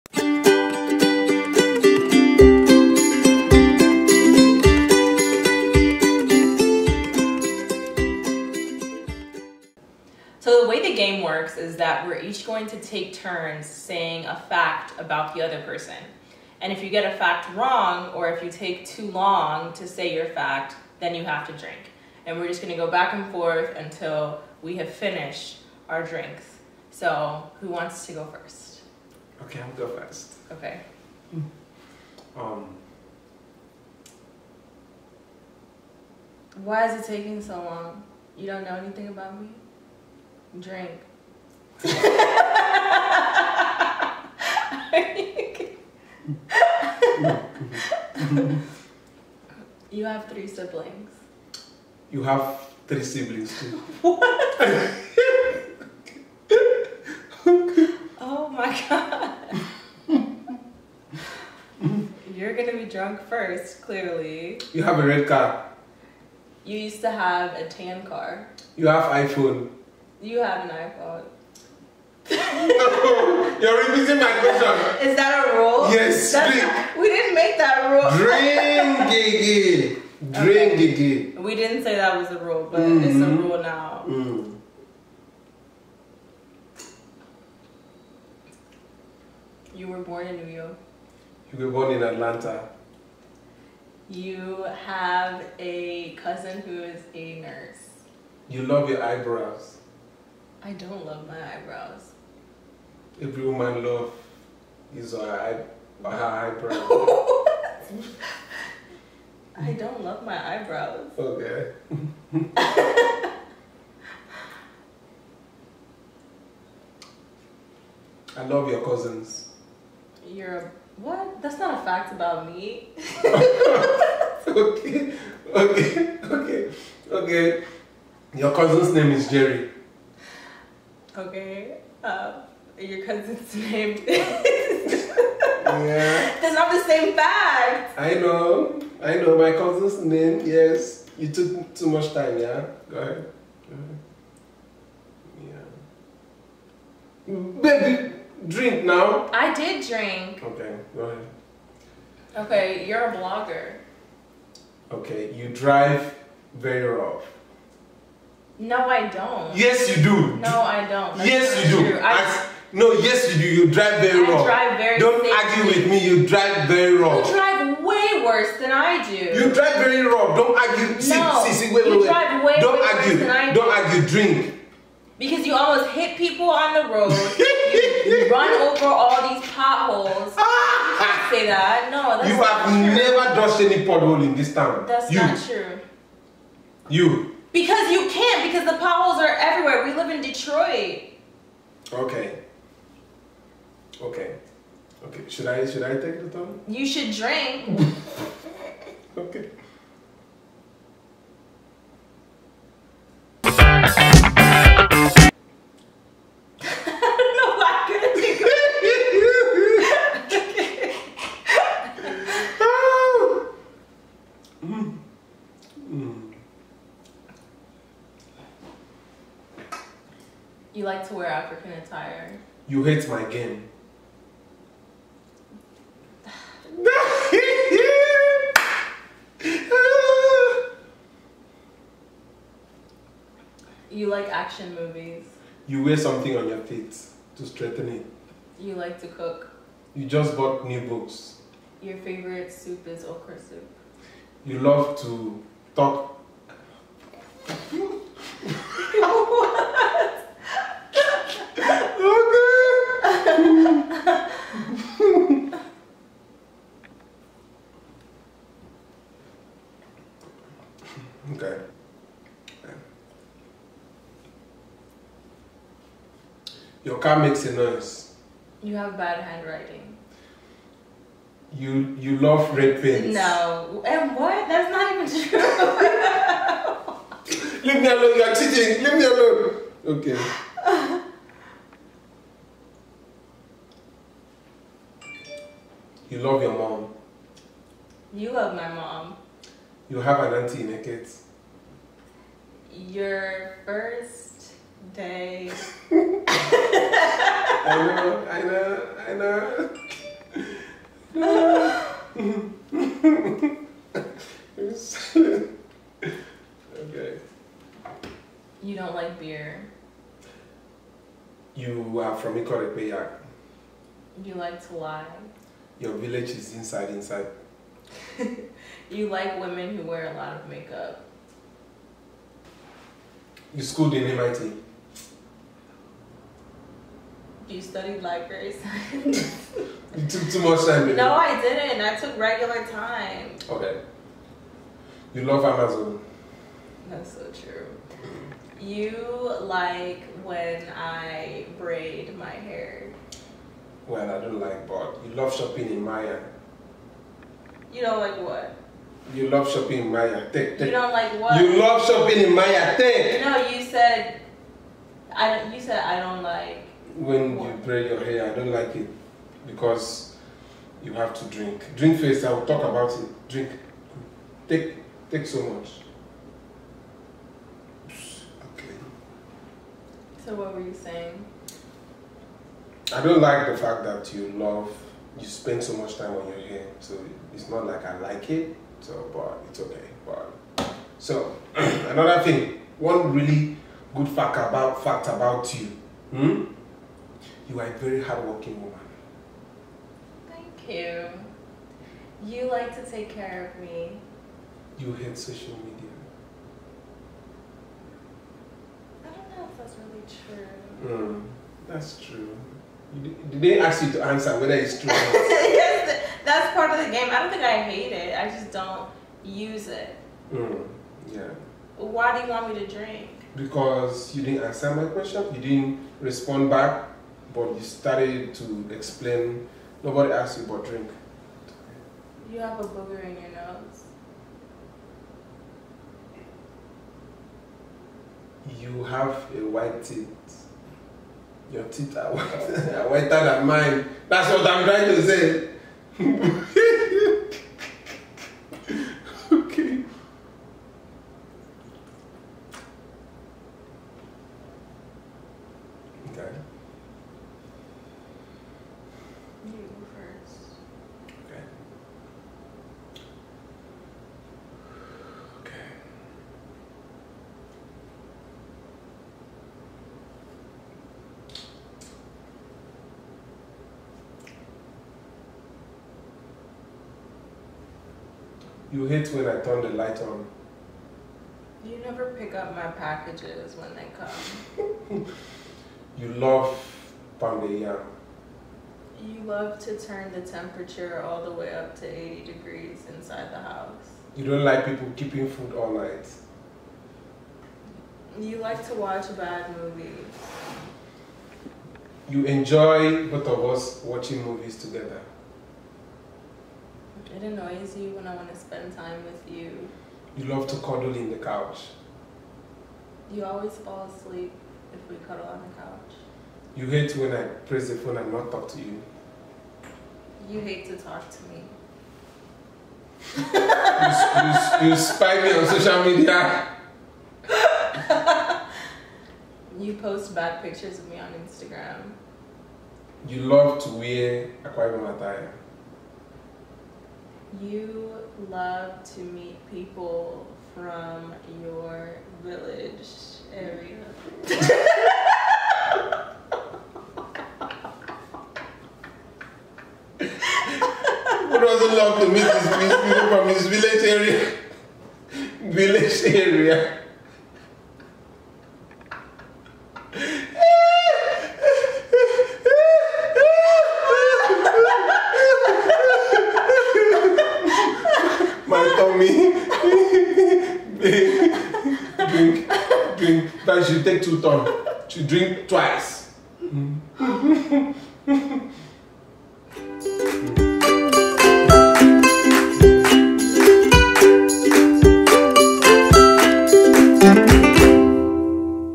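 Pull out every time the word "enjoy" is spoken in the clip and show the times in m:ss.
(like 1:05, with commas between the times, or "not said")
8:12.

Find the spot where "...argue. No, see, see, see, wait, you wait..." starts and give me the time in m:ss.
2:50.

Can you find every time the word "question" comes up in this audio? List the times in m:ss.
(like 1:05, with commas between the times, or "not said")
1:14, 6:54.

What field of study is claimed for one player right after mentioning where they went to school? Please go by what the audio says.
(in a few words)
Library science.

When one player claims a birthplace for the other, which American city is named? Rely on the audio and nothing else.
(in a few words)
Atlanta.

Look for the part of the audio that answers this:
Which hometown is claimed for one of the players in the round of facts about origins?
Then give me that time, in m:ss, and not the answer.
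5:12.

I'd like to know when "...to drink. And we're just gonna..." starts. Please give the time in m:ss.
0:21.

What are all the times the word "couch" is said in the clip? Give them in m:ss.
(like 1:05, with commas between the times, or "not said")
8:21, 8:25.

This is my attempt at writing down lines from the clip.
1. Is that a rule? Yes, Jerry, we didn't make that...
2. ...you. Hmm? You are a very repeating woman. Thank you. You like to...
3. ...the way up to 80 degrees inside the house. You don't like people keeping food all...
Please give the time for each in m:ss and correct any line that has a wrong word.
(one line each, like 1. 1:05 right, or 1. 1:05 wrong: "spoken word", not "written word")
1. 1:15 wrong: "Not", not "Jerry"
2. 6:25 wrong: "hardworking", not "repeating"
3. 8:01 right.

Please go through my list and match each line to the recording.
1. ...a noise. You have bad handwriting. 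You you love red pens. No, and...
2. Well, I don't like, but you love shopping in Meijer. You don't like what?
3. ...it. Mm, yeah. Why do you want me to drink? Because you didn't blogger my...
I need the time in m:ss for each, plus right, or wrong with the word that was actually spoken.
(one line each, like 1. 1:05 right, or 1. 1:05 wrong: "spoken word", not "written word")
1. 4:27 right
2. 5:43 right
3. 6:49 wrong: "answer", not "blogger".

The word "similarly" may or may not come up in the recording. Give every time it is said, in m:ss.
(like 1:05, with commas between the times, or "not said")
not said.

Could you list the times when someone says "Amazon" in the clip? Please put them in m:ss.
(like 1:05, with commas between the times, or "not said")
5:35.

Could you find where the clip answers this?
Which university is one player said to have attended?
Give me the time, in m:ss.
5:24.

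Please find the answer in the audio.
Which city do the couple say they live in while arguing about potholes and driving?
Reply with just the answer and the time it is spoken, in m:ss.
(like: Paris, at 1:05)
Detroit, at 3:10.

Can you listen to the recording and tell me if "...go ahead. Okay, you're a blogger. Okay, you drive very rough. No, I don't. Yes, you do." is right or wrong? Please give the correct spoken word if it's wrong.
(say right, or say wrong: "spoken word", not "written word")
right.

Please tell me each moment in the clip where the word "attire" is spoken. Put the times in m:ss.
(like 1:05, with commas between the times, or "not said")
3:41, 8:44.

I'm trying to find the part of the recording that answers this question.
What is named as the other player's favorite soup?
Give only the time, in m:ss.
4:03.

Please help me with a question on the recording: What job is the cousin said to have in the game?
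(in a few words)
Nurse.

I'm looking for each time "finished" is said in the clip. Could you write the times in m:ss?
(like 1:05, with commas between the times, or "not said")
0:24.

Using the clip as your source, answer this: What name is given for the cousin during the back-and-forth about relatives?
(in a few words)
Jerry.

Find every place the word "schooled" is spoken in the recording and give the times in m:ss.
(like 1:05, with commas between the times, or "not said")
5:23.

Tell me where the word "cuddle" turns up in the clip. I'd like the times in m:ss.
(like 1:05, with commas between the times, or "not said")
8:20, 8:25.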